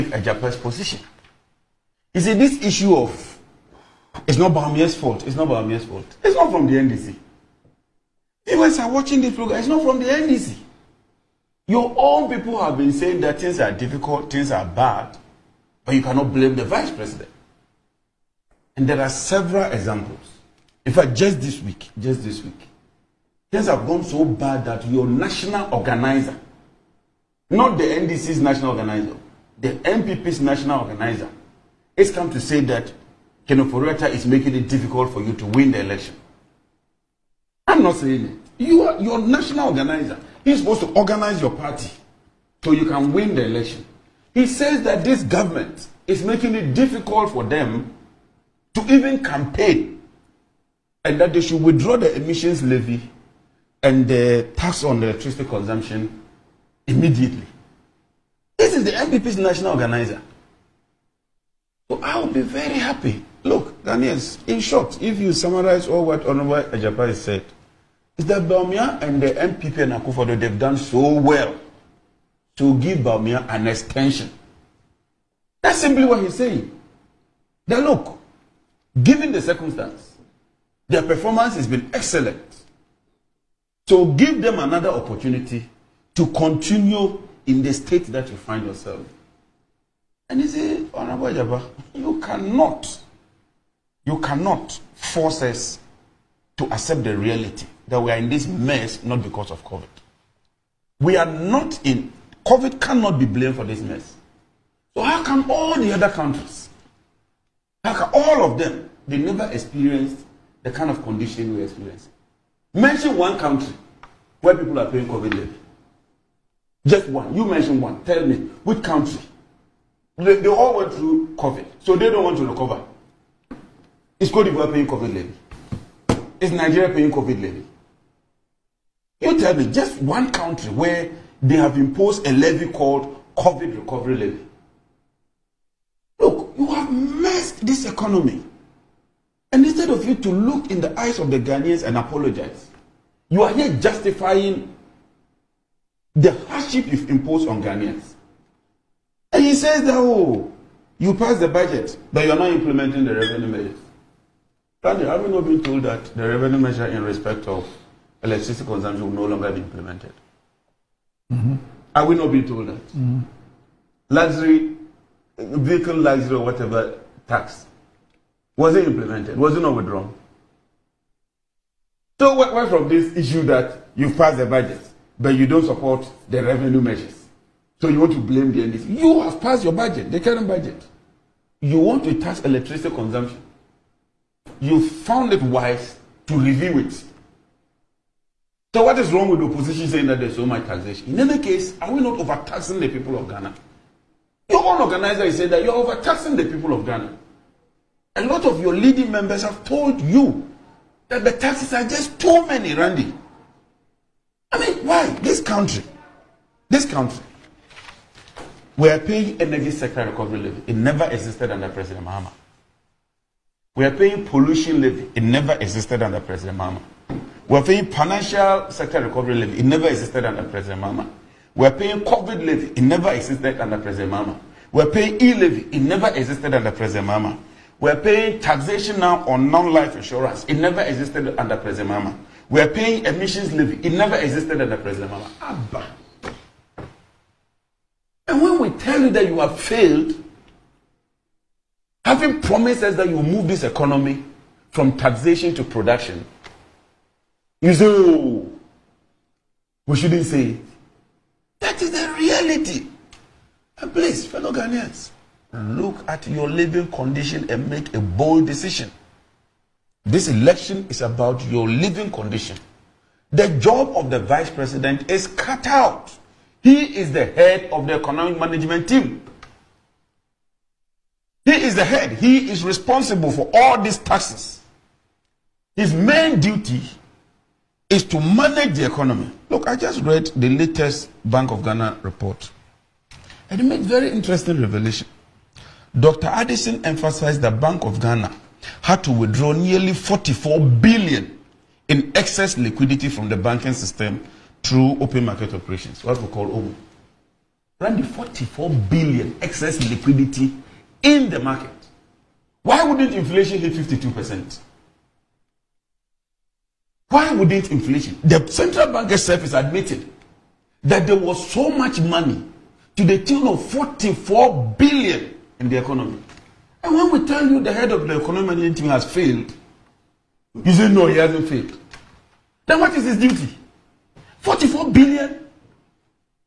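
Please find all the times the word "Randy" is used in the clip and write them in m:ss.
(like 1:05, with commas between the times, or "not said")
3:22.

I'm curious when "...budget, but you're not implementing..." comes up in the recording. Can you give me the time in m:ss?
2:31.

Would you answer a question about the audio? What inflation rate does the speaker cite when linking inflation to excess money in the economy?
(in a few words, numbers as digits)
52%.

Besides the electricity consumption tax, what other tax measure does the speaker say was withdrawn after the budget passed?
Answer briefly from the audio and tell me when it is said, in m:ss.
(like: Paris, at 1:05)
Luxury vehicle license, at 2:44.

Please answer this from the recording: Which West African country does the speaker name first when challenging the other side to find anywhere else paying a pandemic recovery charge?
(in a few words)
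Cote d'Ivoire.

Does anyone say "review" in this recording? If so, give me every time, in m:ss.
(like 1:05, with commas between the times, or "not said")
3:06.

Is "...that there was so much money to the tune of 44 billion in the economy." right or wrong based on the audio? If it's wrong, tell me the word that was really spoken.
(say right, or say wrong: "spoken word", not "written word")
right.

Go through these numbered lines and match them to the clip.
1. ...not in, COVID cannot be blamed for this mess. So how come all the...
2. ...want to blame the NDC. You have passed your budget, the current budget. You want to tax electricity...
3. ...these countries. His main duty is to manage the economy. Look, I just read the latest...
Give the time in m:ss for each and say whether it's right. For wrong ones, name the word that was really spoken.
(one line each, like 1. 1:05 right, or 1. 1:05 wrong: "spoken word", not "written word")
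1. 1:41 right
2. 2:57 right
3. 4:33 wrong: "taxes", not "countries".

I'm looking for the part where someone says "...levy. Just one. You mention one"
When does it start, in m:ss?
1:55.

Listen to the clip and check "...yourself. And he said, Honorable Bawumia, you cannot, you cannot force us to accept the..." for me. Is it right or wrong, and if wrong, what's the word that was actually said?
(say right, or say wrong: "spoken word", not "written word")
wrong: "Jabba", not "Bawumia".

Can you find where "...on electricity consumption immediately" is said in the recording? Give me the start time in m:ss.
0:54.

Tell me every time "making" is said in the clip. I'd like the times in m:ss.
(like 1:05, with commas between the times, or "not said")
0:34, 0:46.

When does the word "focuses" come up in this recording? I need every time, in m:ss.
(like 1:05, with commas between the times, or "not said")
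not said.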